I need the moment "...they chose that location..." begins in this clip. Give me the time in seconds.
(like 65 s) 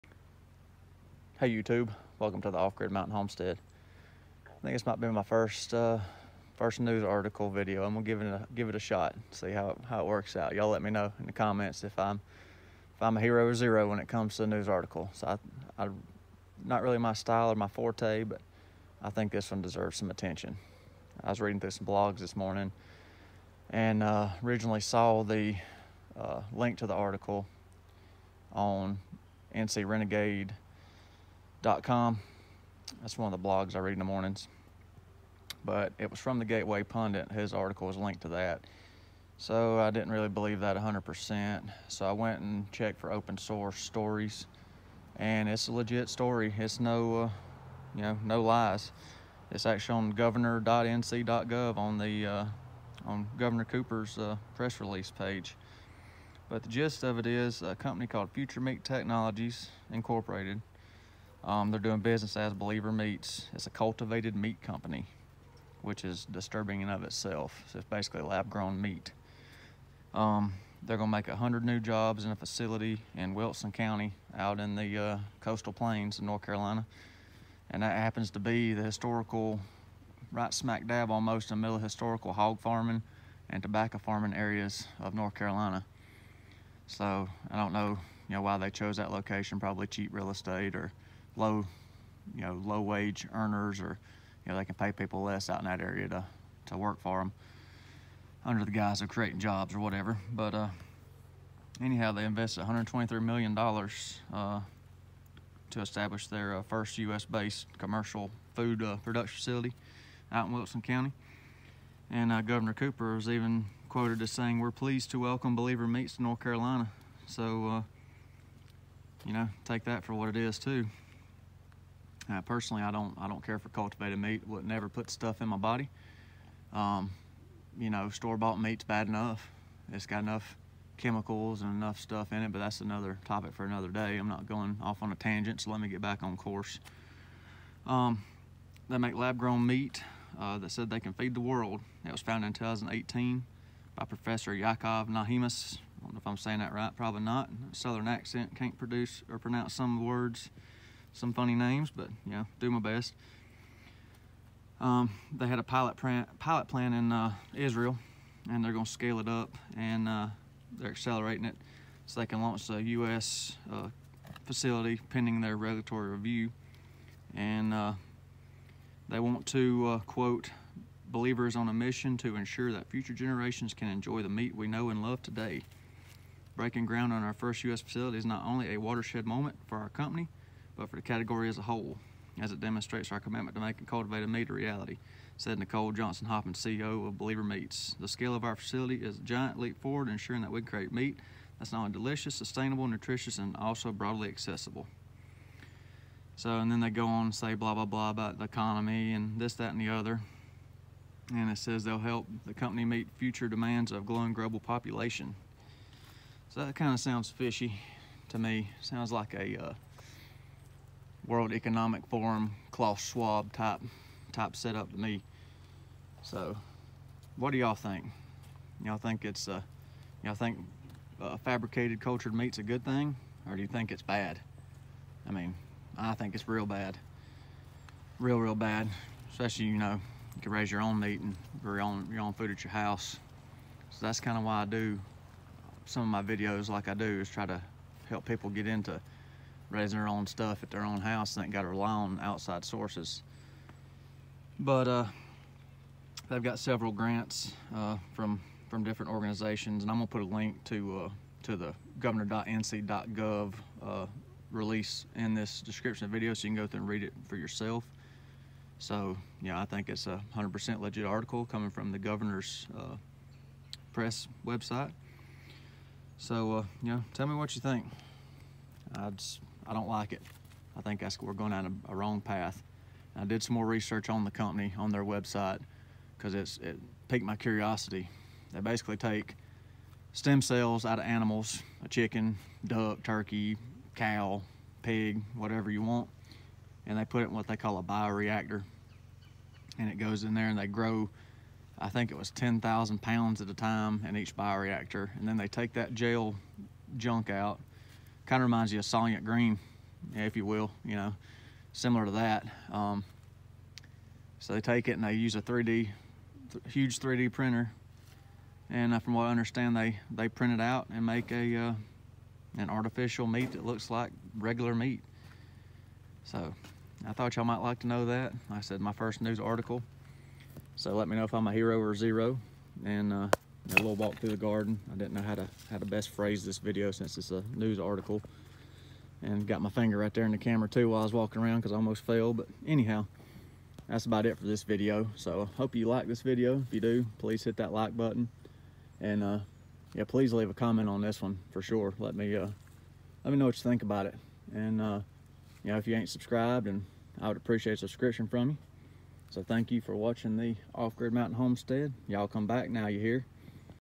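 88 s.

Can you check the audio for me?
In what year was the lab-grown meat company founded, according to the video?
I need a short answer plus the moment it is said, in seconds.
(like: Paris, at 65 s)
2018, at 142 s.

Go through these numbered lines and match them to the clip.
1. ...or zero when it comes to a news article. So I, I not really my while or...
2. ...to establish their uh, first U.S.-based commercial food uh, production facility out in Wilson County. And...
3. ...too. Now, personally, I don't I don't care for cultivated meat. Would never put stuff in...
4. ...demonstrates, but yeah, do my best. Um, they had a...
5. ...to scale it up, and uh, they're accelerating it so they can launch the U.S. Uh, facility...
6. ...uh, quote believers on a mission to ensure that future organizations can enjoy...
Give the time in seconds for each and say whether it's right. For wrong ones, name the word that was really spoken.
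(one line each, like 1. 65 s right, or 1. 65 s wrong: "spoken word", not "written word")
1. 13 s wrong: "style", not "while"
2. 105 s right
3. 120 s right
4. 151 s wrong: "names", not "demonstrates"
5. 158 s right
6. 169 s wrong: "generations", not "organizations".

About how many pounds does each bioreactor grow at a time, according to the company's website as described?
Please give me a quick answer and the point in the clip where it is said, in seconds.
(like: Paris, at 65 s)
10,000 pounds, at 292 s.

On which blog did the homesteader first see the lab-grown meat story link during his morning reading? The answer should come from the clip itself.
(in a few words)
NC Renegade.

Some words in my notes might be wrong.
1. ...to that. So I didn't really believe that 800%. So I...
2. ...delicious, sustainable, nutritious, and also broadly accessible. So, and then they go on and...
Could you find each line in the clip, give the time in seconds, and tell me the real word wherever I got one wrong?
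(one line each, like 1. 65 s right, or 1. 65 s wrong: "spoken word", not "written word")
1. 38 s wrong: "100", not "800"
2. 191 s right.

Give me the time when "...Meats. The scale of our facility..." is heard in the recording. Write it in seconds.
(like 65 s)
187 s.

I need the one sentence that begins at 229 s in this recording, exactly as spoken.
Especially you know, you can raise your own meat and your own your own food at your house.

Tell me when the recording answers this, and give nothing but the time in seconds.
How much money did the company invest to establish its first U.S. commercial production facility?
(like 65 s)
102 s.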